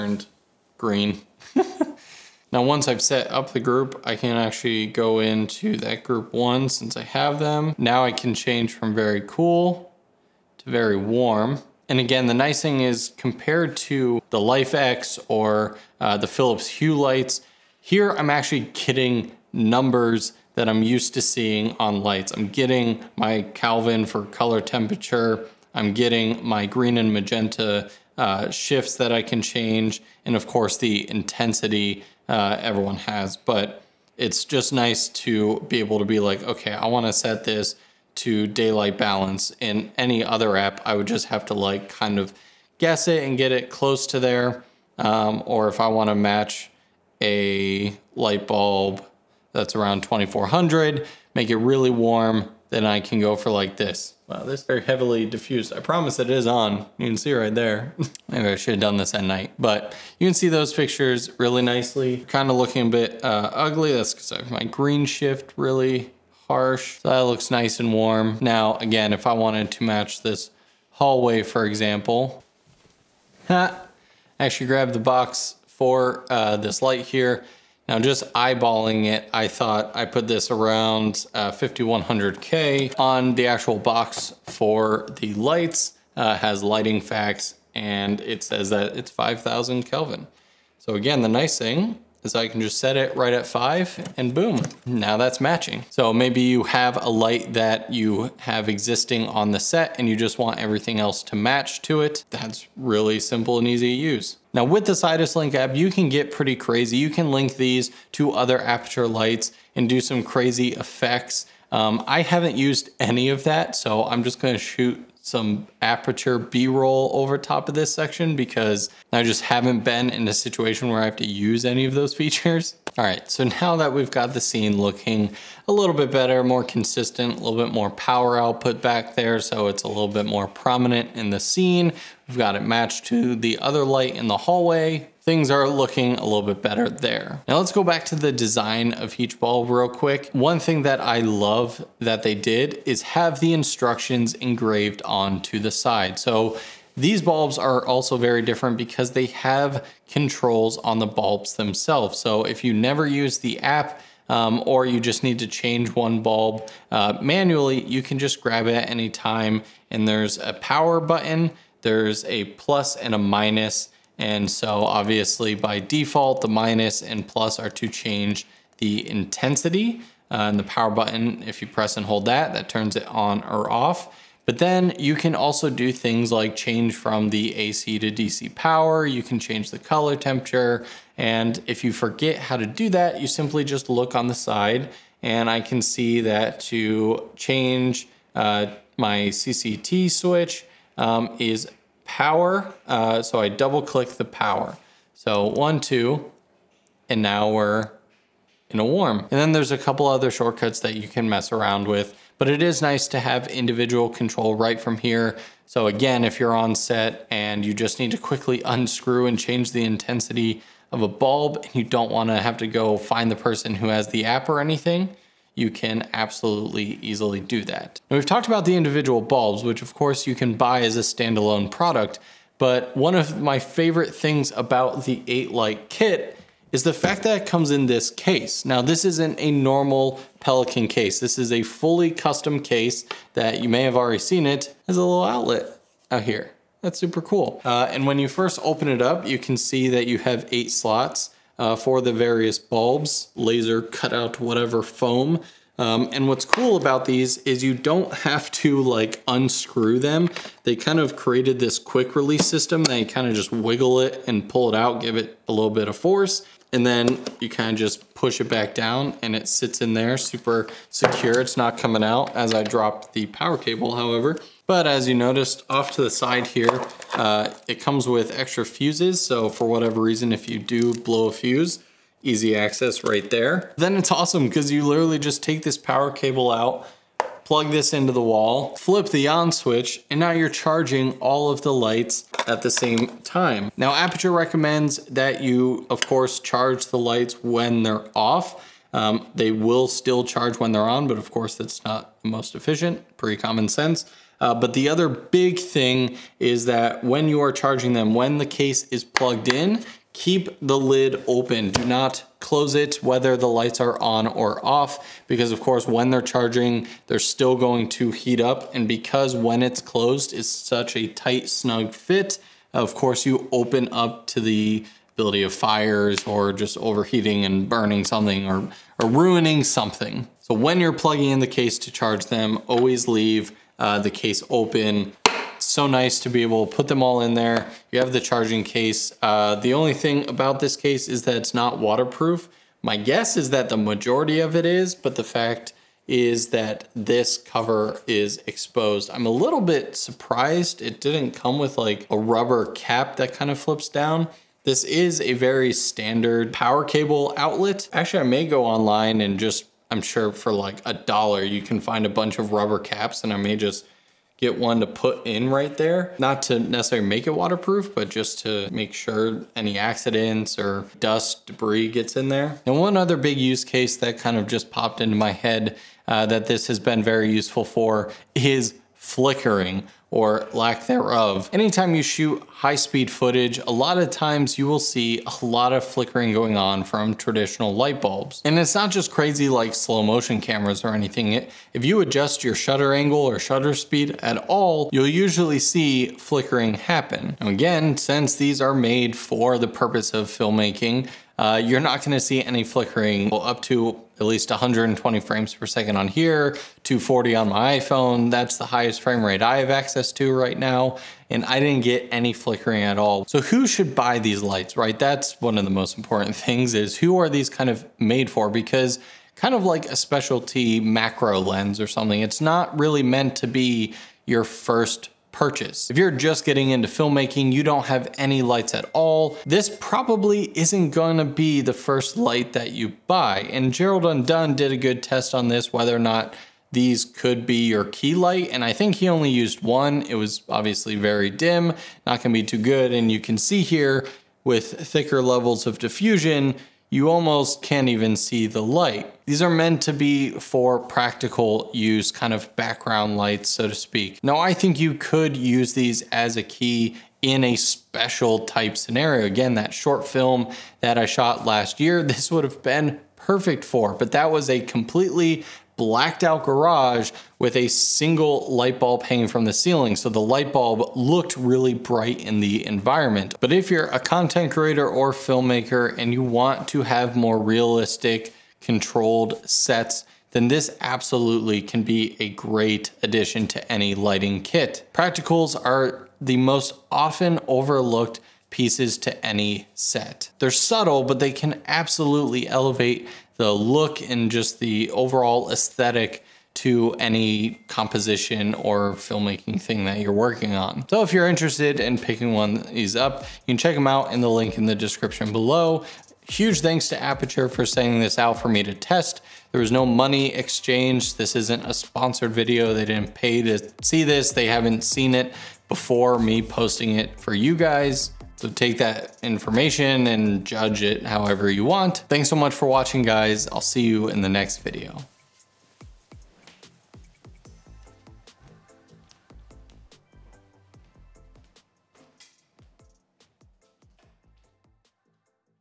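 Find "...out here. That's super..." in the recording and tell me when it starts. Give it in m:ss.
3:56.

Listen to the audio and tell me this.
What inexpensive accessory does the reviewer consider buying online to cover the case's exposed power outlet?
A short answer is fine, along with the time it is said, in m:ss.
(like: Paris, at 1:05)
rubber caps, at 5:52.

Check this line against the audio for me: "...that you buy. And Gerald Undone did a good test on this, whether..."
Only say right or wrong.
right.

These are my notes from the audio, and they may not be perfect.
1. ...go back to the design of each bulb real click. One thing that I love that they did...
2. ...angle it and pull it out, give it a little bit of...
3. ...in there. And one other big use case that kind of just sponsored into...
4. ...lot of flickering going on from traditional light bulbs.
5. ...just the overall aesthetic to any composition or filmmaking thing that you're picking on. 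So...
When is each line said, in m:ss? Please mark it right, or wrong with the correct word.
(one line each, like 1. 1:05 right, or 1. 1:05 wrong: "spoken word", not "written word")
1. 2:17 wrong: "quick", not "click"
2. 4:13 wrong: "wiggle", not "angle"
3. 6:02 wrong: "popped", not "sponsored"
4. 6:15 right
5. 8:04 wrong: "working", not "picking".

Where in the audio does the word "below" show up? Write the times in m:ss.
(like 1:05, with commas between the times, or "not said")
8:15.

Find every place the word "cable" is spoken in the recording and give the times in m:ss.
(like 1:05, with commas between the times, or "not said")
4:23, 4:36, 5:46.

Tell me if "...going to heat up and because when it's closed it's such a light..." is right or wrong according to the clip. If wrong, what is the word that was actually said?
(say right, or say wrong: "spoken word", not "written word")
wrong: "tight", not "light".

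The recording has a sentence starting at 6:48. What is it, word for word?
Because kind of like a specialty macro lens or something, it's not really meant to be your first purchase.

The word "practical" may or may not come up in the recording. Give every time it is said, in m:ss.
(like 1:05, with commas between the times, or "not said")
7:20, 7:54.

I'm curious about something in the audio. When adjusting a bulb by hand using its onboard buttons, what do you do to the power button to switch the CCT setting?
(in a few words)
double click.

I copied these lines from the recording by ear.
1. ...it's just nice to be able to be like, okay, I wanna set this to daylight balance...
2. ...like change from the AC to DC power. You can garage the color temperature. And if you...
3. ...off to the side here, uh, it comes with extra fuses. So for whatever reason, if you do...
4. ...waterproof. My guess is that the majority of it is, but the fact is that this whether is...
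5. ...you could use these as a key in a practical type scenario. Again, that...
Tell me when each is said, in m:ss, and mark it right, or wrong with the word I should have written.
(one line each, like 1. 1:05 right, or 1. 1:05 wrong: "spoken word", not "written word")
1. 0:34 right
2. 2:56 wrong: "change", not "garage"
3. 4:25 right
4. 5:31 wrong: "cover", not "whether"
5. 7:24 wrong: "special", not "practical".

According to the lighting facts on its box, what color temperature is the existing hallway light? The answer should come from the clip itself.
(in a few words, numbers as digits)
5000 Kelvin.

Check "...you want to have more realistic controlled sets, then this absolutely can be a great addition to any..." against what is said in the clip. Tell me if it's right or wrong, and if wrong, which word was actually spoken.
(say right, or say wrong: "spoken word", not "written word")
right.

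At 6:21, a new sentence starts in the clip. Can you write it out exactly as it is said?
If you adjust your shutter angle or shutter speed at all, you'll usually see flickering happen.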